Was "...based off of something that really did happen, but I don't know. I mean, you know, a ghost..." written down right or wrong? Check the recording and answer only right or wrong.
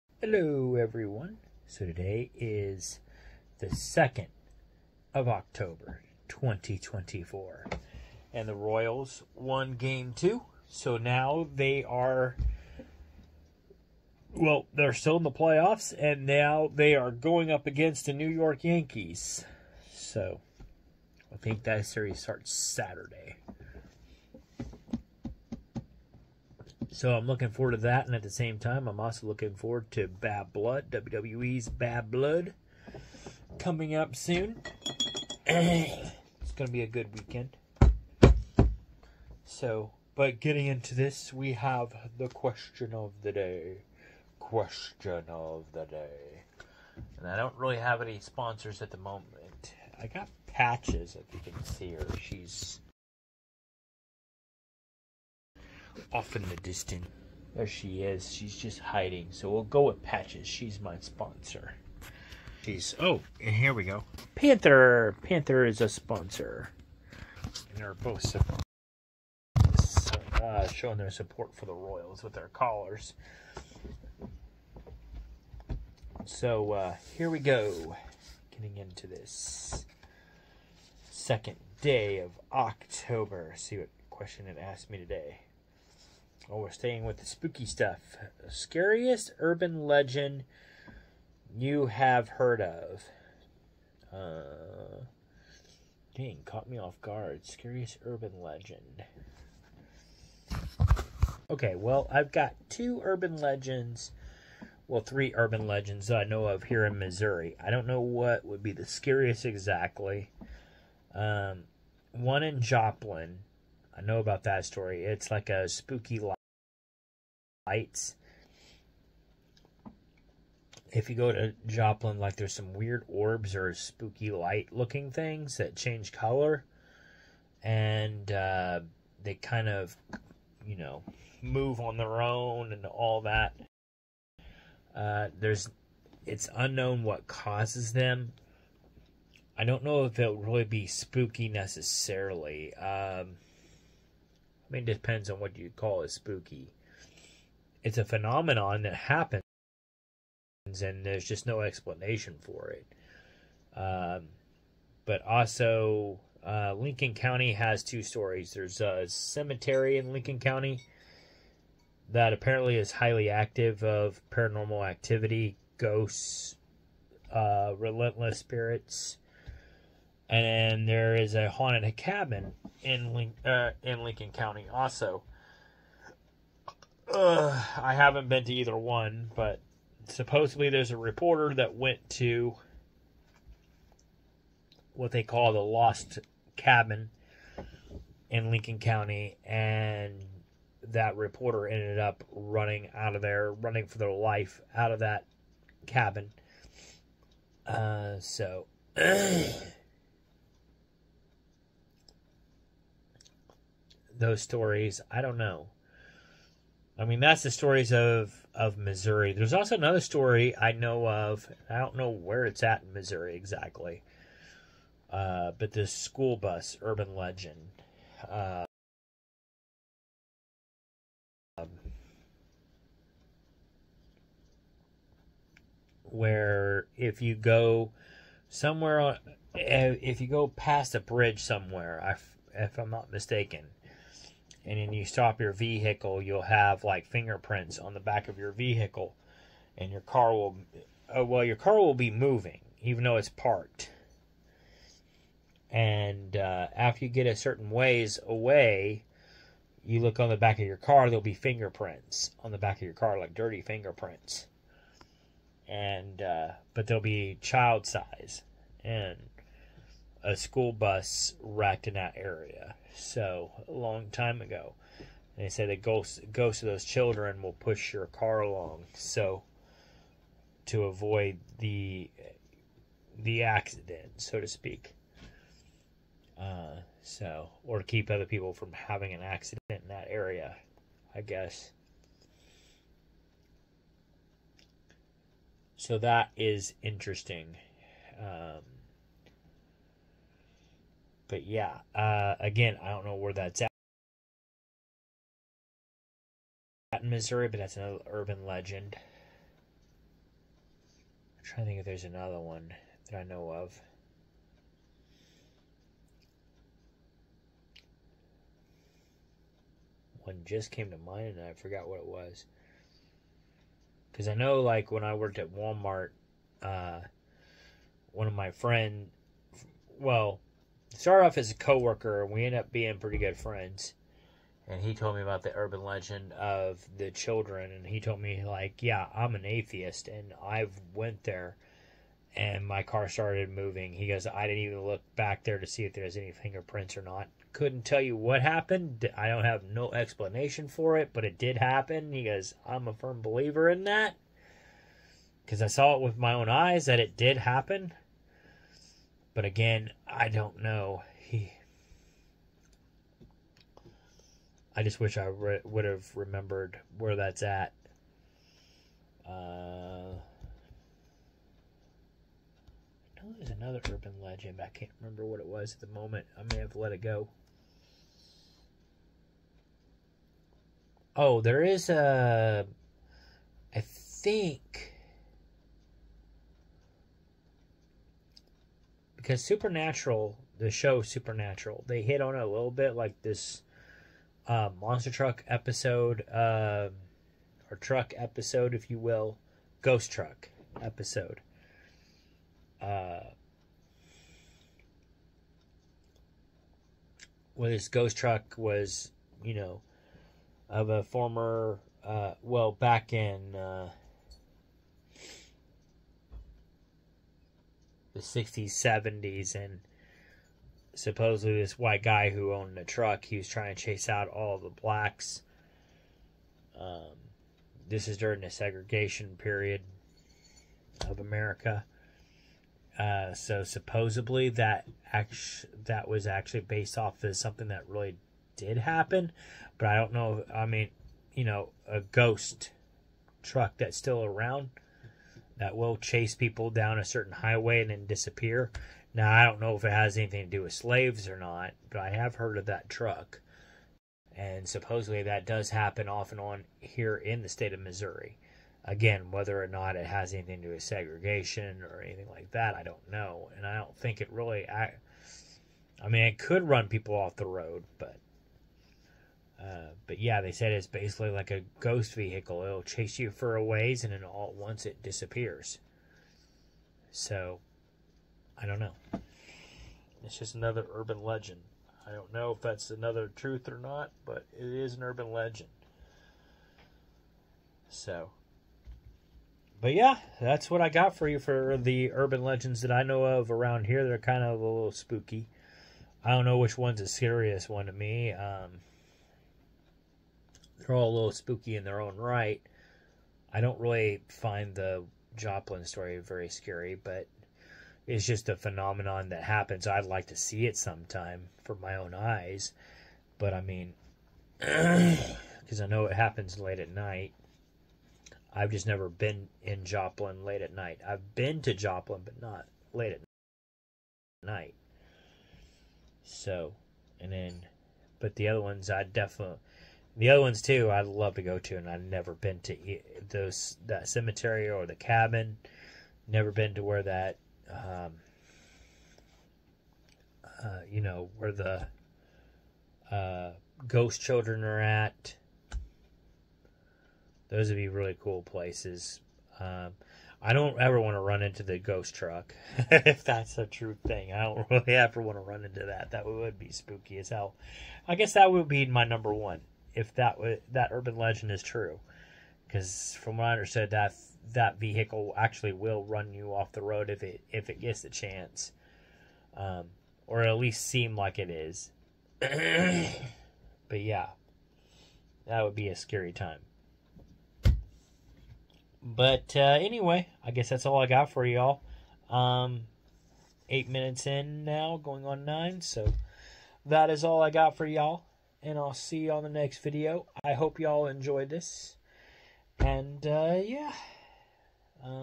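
right.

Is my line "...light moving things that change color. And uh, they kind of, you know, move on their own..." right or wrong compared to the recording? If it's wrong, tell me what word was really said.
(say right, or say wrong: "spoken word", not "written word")
wrong: "looking", not "moving".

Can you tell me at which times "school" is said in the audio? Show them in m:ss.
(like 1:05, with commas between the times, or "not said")
3:35, 4:20.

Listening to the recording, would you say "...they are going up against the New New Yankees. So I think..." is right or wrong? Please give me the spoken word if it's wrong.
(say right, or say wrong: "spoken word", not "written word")
wrong: "York", not "New".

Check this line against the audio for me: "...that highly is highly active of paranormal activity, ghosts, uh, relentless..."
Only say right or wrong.
wrong.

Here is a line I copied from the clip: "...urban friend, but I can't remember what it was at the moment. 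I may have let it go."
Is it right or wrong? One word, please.
wrong.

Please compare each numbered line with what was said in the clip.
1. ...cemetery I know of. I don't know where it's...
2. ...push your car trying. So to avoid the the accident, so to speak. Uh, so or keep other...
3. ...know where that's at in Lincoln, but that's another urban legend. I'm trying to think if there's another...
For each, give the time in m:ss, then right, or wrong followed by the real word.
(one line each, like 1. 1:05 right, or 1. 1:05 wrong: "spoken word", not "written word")
1. 3:30 wrong: "story", not "cemetery"
2. 4:27 wrong: "along", not "trying"
3. 4:53 wrong: "Missouri", not "Lincoln".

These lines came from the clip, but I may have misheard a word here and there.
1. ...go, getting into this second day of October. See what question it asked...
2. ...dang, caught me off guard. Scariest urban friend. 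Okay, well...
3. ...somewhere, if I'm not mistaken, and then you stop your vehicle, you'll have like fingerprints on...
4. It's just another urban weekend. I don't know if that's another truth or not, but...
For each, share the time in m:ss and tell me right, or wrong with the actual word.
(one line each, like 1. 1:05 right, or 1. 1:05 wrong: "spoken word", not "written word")
1. 1:17 right
2. 1:36 wrong: "legend", not "friend"
3. 3:51 right
4. 7:50 wrong: "legend", not "weekend".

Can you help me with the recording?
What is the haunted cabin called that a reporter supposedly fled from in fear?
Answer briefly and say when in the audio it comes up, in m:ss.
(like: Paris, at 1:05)
Lost Cabin, at 3:05.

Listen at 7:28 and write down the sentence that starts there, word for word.
Again, whether or not it has anything to do with segregation or anything like that, I don't know.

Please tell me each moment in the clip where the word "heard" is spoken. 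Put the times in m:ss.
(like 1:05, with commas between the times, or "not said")
1:32, 7:22.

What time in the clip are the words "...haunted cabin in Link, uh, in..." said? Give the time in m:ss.
2:51.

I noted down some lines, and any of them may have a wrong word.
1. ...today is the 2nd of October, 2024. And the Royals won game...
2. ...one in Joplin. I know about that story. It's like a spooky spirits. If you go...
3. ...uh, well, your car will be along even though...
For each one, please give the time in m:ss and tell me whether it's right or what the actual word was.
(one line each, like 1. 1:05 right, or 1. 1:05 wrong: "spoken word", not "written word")
1. 0:01 right
2. 1:52 wrong: "lights", not "spirits"
3. 4:01 wrong: "moving", not "along".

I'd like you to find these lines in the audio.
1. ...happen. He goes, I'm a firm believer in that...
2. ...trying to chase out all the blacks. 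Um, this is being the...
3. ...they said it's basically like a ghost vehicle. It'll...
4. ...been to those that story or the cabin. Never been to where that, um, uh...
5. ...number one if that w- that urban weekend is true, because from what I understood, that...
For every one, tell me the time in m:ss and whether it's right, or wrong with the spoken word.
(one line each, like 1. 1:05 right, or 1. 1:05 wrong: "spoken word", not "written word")
1. 5:41 right
2. 6:53 wrong: "during", not "being"
3. 7:40 right
4. 8:42 wrong: "cemetery", not "story"
5. 9:09 wrong: "legend", not "weekend".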